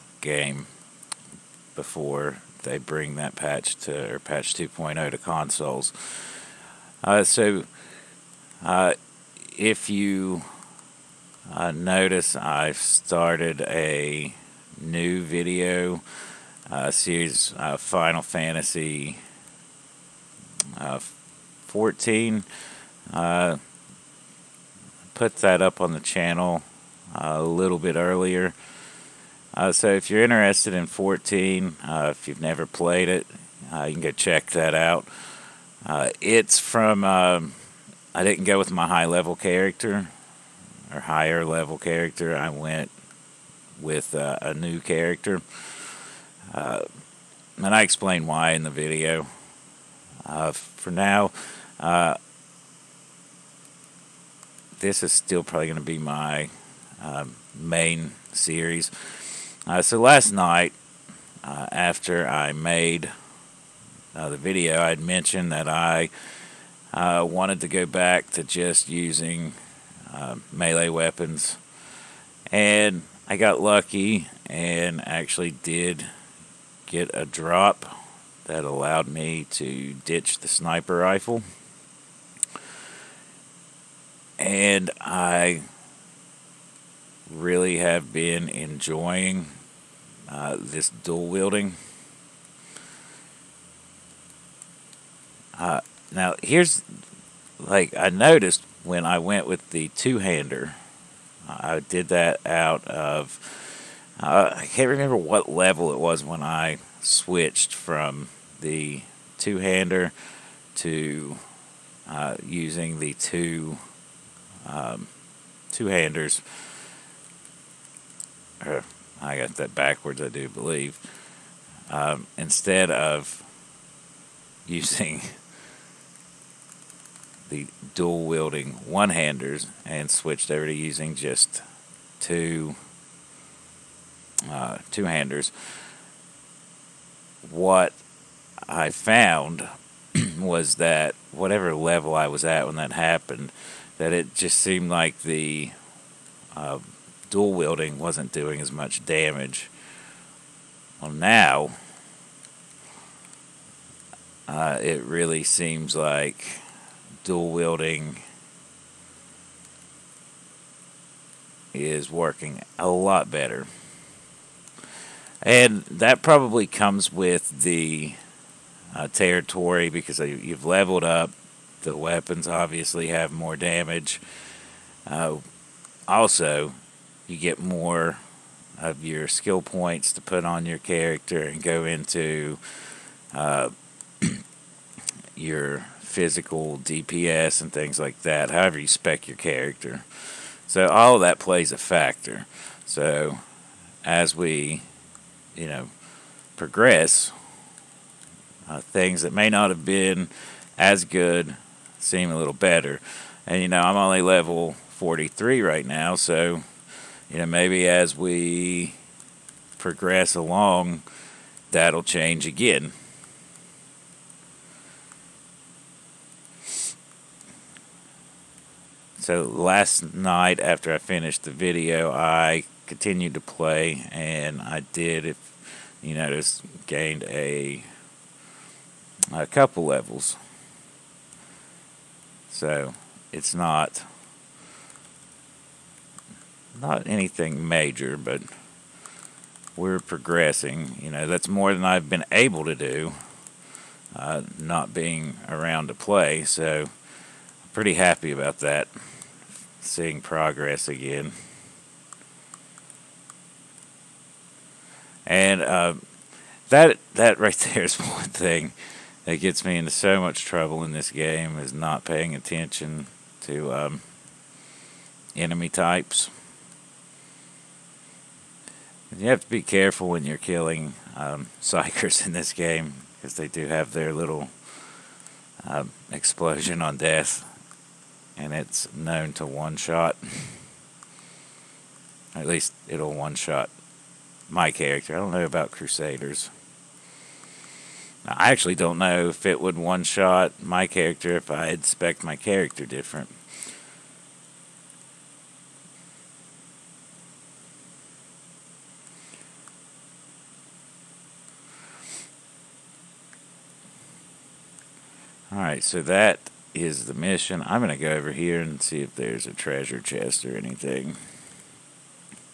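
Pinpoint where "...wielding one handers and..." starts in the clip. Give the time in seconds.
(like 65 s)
128 s.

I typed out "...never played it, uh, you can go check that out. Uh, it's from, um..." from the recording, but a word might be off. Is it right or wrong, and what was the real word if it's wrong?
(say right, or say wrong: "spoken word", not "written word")
right.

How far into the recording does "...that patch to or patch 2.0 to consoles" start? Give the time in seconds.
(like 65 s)
3 s.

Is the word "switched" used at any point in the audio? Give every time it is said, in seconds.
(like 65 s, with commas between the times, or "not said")
107 s, 130 s.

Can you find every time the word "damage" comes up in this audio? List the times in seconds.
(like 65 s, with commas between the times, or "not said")
149 s, 173 s.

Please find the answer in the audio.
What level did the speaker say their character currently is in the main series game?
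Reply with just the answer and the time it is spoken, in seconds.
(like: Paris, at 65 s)
43, at 204 s.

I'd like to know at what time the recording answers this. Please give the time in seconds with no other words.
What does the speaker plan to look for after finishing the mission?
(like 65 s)
309 s.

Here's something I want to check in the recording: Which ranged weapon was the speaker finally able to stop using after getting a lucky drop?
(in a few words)
Sniper rifle.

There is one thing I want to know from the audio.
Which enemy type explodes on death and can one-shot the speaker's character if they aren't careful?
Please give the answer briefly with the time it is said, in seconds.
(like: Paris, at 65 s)
Psykers, at 271 s.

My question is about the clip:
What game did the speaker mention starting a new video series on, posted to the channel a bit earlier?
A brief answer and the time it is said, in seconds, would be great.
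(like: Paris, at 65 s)
Final Fantasy 14, at 17 s.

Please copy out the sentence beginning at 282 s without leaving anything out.
At least it'll one shot my character.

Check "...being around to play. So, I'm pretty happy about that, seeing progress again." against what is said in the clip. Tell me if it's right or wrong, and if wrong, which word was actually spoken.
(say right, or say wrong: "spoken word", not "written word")
right.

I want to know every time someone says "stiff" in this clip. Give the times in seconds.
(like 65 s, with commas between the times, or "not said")
not said.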